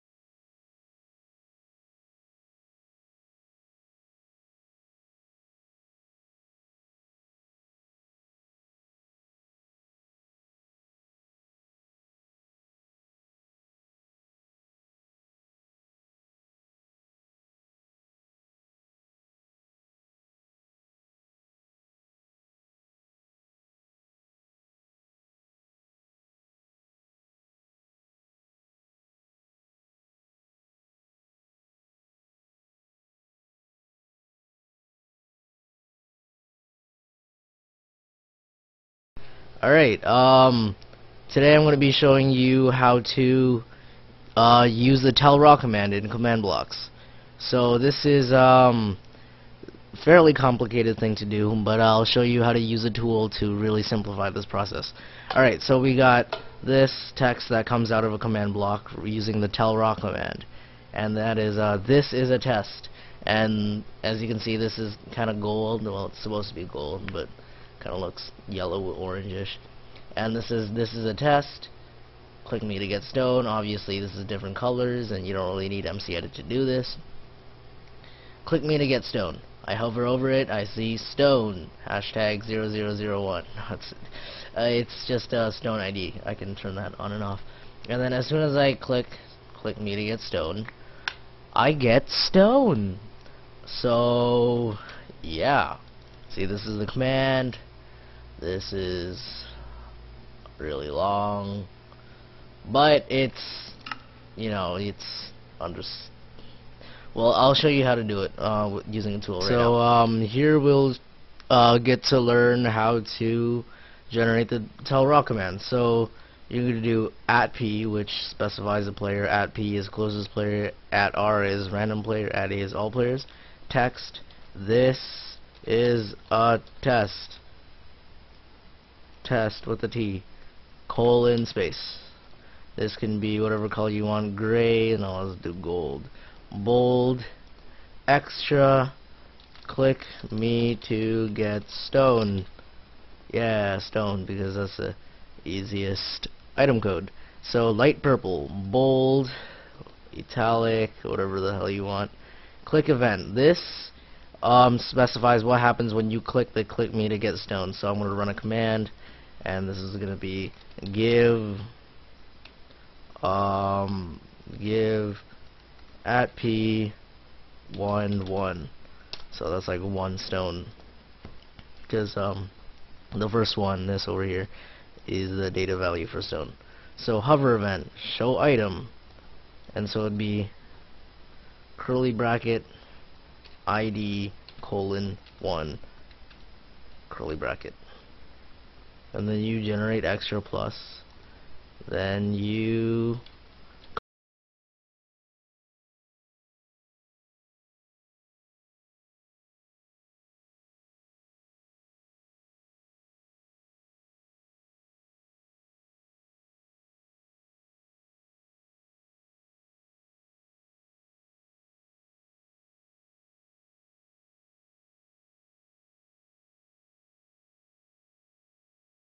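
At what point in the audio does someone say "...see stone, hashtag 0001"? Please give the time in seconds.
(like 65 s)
80 s.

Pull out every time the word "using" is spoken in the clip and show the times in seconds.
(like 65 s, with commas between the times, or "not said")
59 s, 108 s.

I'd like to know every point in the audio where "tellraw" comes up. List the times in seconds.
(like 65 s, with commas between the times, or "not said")
45 s, 59 s, 114 s.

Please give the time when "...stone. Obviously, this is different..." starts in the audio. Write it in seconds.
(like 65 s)
73 s.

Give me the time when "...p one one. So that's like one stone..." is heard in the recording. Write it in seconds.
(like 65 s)
166 s.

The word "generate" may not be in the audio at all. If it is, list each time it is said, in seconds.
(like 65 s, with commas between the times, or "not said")
114 s, 189 s.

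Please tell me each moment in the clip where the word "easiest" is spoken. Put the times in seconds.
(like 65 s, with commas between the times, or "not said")
145 s.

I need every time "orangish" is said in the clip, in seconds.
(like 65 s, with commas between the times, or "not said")
68 s.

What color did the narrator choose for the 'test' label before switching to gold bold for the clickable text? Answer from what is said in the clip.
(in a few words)
gray.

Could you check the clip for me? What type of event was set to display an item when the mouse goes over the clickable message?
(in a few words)
hover event.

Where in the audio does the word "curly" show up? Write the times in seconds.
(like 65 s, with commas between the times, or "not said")
181 s, 187 s.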